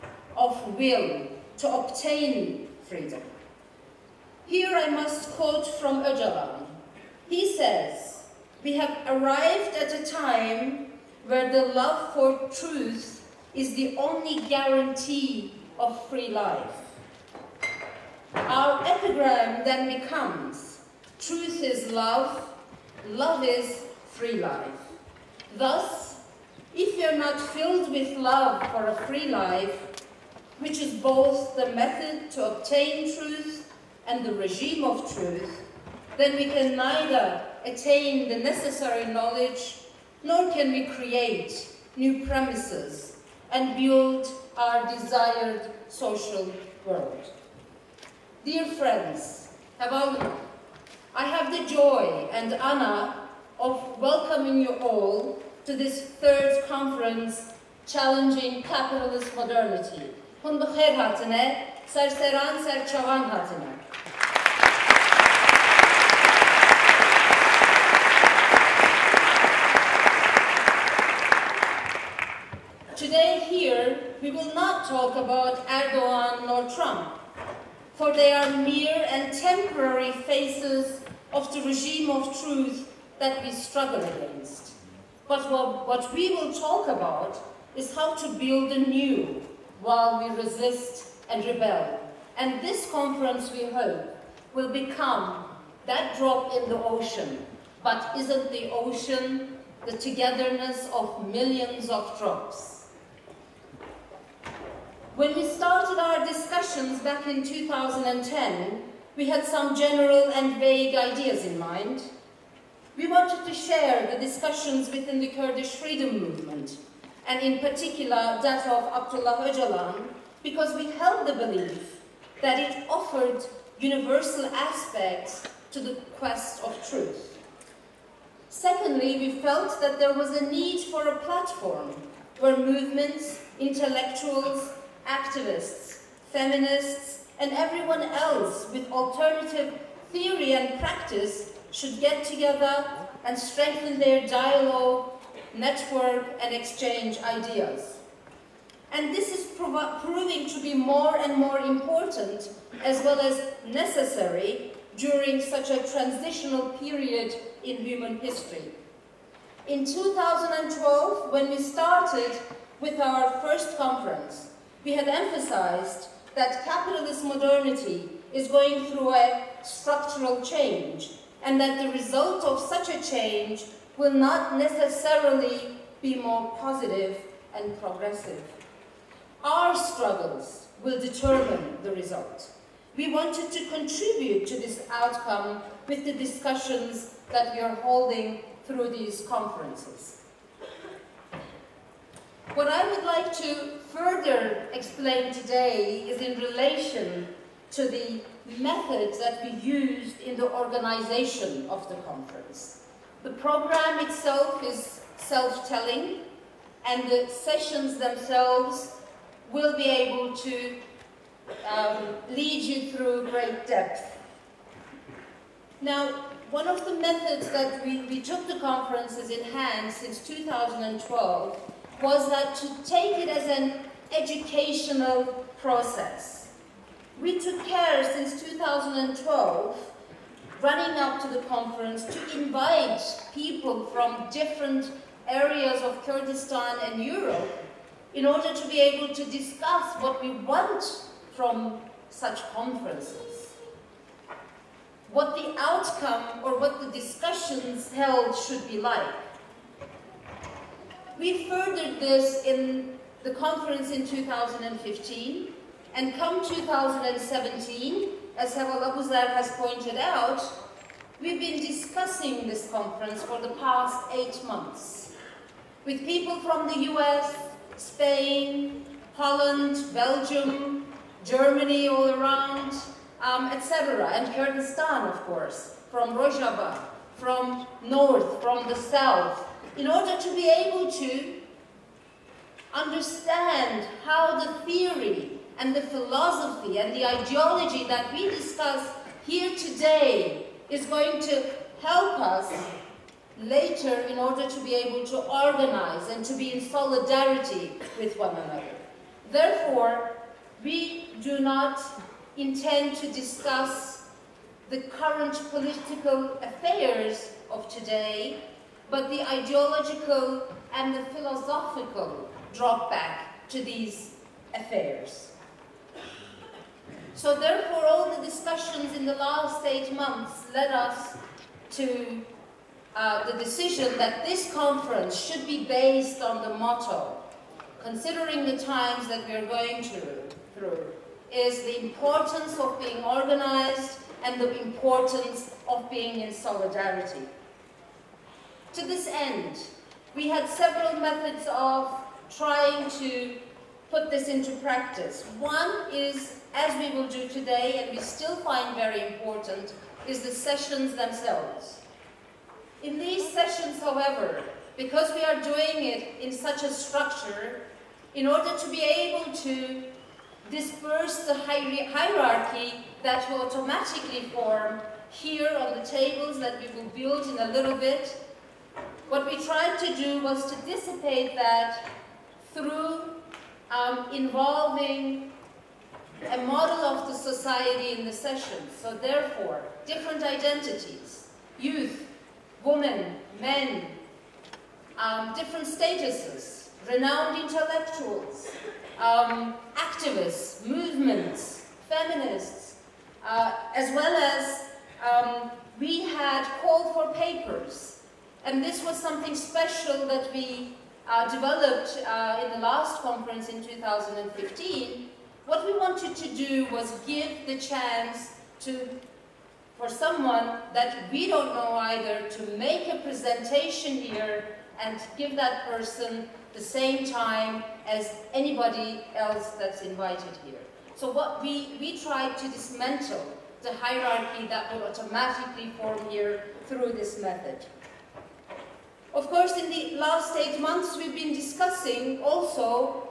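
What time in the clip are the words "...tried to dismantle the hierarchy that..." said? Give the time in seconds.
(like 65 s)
421 s.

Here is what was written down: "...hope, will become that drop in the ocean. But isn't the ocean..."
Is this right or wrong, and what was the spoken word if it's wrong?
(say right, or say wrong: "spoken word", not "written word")
right.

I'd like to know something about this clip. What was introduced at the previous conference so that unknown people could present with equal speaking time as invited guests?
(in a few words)
call for papers.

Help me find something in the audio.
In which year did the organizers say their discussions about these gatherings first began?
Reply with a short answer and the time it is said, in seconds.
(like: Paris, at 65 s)
2010, at 107 s.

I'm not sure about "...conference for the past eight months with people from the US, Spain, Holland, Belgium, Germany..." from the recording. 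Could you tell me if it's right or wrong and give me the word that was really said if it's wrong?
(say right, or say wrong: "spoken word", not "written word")
right.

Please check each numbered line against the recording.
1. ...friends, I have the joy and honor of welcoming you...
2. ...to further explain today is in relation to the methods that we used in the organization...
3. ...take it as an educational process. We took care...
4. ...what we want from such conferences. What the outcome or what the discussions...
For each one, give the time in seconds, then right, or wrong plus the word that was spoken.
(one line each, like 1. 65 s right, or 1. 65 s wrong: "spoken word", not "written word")
1. 48 s right
2. 193 s right
3. 222 s right
4. 240 s right.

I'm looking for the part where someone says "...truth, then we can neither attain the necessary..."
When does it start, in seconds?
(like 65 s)
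35 s.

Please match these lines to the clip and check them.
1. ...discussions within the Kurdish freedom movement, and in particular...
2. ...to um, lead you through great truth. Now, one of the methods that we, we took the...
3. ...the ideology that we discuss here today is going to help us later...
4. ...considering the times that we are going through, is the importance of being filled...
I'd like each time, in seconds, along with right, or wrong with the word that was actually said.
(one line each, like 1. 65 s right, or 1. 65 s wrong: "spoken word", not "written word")
1. 114 s right
2. 210 s wrong: "depth", not "truth"
3. 286 s right
4. 327 s wrong: "organized", not "filled".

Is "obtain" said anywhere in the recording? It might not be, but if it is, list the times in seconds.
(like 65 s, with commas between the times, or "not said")
1 s, 32 s.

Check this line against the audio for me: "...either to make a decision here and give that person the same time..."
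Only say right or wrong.
wrong.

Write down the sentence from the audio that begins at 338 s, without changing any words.
To this end, we had several methods of trying to put this into practice.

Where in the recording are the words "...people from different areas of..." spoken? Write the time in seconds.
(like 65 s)
233 s.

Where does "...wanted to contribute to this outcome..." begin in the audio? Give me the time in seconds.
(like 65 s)
183 s.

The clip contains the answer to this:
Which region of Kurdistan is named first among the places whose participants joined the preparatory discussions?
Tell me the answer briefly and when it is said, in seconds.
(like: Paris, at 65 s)
Rojava, at 276 s.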